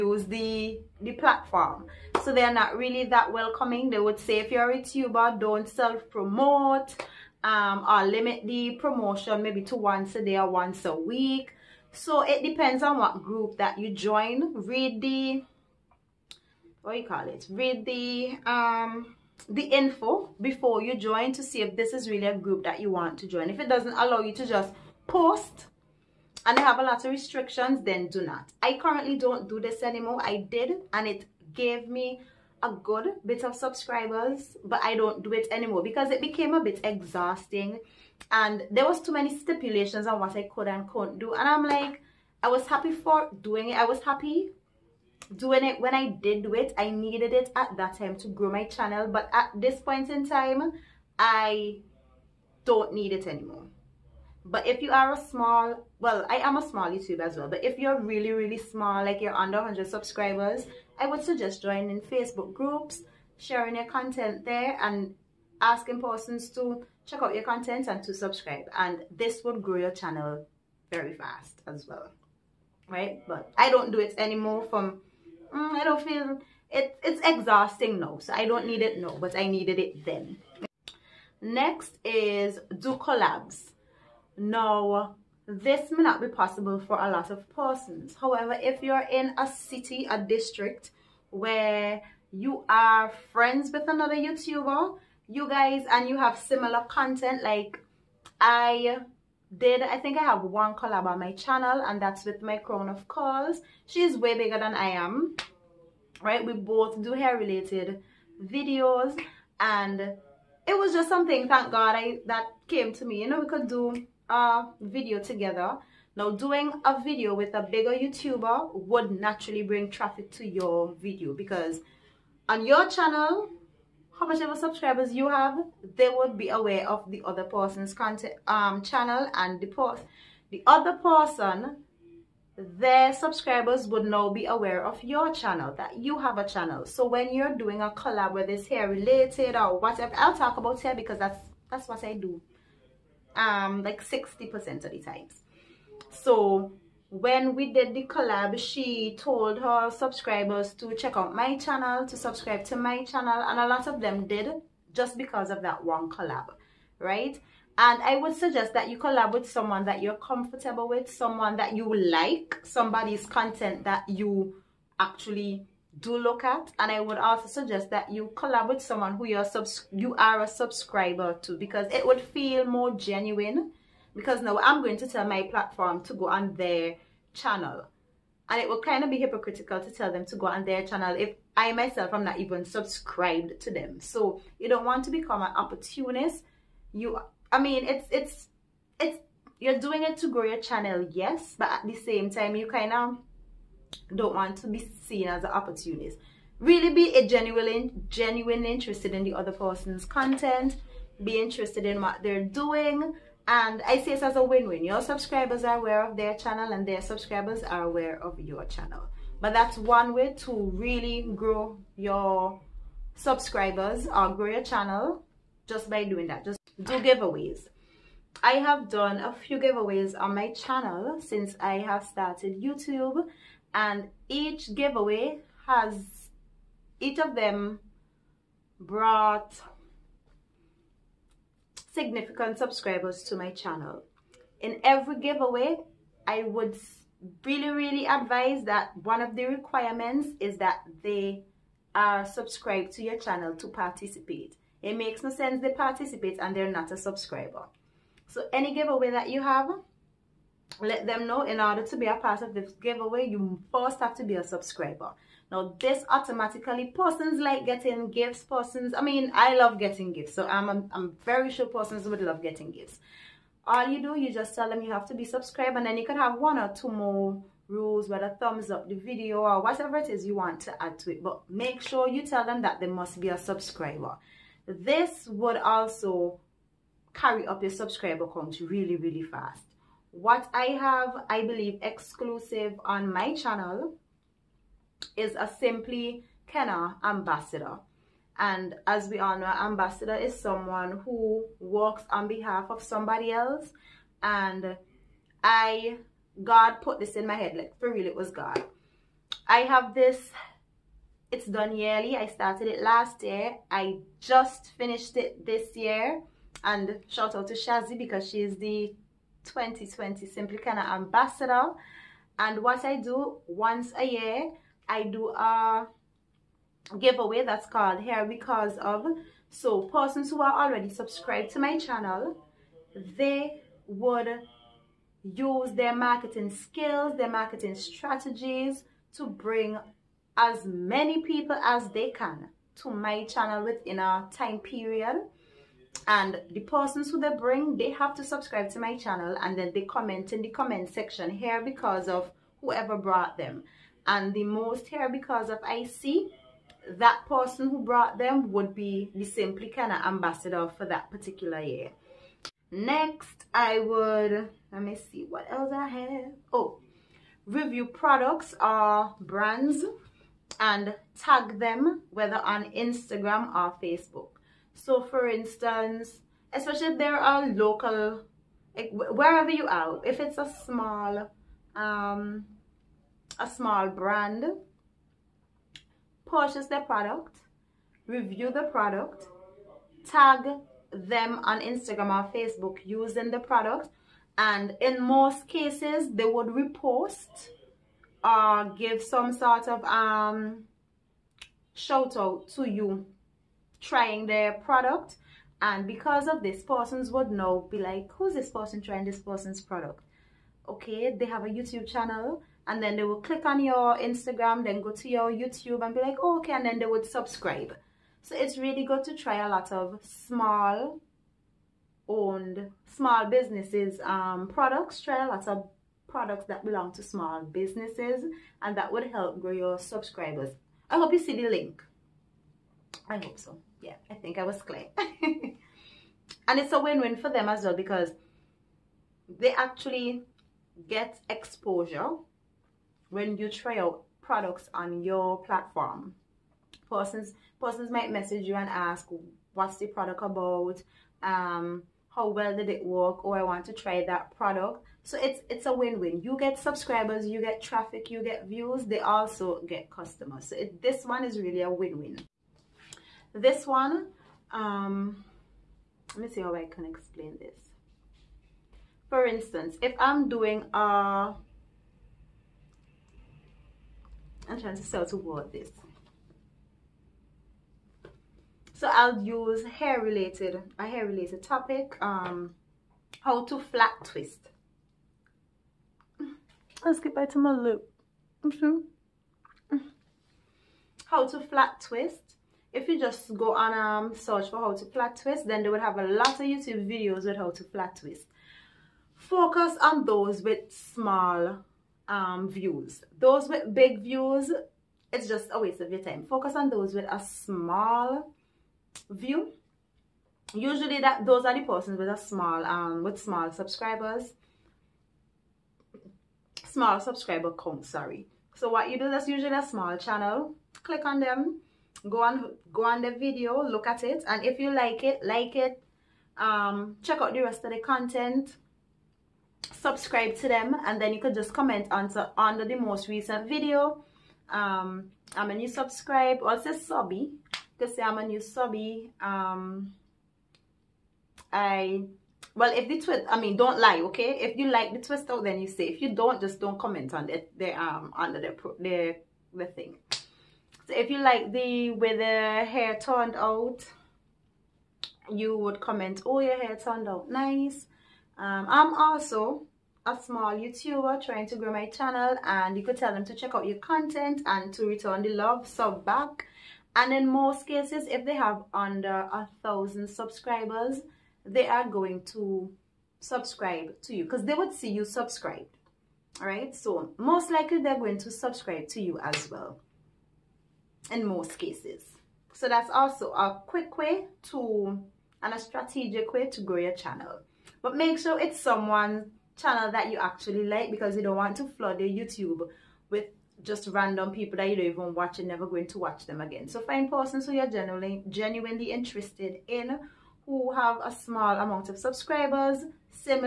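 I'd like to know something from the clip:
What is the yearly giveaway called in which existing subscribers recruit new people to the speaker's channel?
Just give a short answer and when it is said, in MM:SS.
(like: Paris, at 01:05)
Hair Because Of, at 05:18.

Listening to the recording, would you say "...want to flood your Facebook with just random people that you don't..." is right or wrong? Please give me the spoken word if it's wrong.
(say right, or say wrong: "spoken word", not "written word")
wrong: "YouTube", not "Facebook".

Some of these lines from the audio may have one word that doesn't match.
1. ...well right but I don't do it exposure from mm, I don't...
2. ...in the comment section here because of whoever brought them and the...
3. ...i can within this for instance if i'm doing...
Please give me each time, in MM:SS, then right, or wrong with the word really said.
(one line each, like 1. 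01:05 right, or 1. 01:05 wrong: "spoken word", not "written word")
1. 01:11 wrong: "anymore", not "exposure"
2. 05:40 right
3. 07:36 wrong: "explain", not "within".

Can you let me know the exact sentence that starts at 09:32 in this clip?
So that's also a quick way to and a strategic way to grow your channel.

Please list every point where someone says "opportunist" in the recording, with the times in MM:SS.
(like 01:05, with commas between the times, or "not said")
03:05, 03:15.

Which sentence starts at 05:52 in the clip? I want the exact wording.
Next, I would, let me see what else I have.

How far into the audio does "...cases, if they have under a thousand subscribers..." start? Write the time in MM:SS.
09:17.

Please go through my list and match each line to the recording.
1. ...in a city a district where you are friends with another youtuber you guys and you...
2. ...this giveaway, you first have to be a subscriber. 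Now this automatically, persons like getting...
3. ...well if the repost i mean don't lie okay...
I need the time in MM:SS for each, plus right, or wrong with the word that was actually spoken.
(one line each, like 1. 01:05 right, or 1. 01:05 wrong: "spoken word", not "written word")
1. 01:29 right
2. 04:12 right
3. 08:52 wrong: "twist", not "repost".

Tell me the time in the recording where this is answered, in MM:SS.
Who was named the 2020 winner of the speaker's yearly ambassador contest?
05:07.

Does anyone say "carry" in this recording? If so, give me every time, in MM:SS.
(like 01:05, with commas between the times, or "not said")
04:37.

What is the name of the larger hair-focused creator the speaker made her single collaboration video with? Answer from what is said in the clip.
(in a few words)
My Crown of Curls.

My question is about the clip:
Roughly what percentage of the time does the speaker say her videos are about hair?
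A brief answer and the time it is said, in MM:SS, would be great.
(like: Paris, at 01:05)
60 percent, at 02:24.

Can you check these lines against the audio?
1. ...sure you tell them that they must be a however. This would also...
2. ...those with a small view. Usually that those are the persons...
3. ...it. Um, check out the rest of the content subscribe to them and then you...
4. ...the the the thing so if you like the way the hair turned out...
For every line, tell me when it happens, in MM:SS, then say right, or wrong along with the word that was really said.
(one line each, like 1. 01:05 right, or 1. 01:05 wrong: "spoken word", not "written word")
1. 04:31 wrong: "subscriber", not "however"
2. 08:16 right
3. 08:35 right
4. 08:58 right.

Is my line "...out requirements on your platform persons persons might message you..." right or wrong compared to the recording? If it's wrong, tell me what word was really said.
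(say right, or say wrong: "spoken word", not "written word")
wrong: "products", not "requirements".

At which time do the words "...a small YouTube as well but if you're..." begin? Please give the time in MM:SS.
00:56.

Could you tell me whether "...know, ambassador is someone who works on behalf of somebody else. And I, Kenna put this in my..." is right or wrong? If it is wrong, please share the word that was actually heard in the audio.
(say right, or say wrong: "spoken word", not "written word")
wrong: "God", not "Kenna".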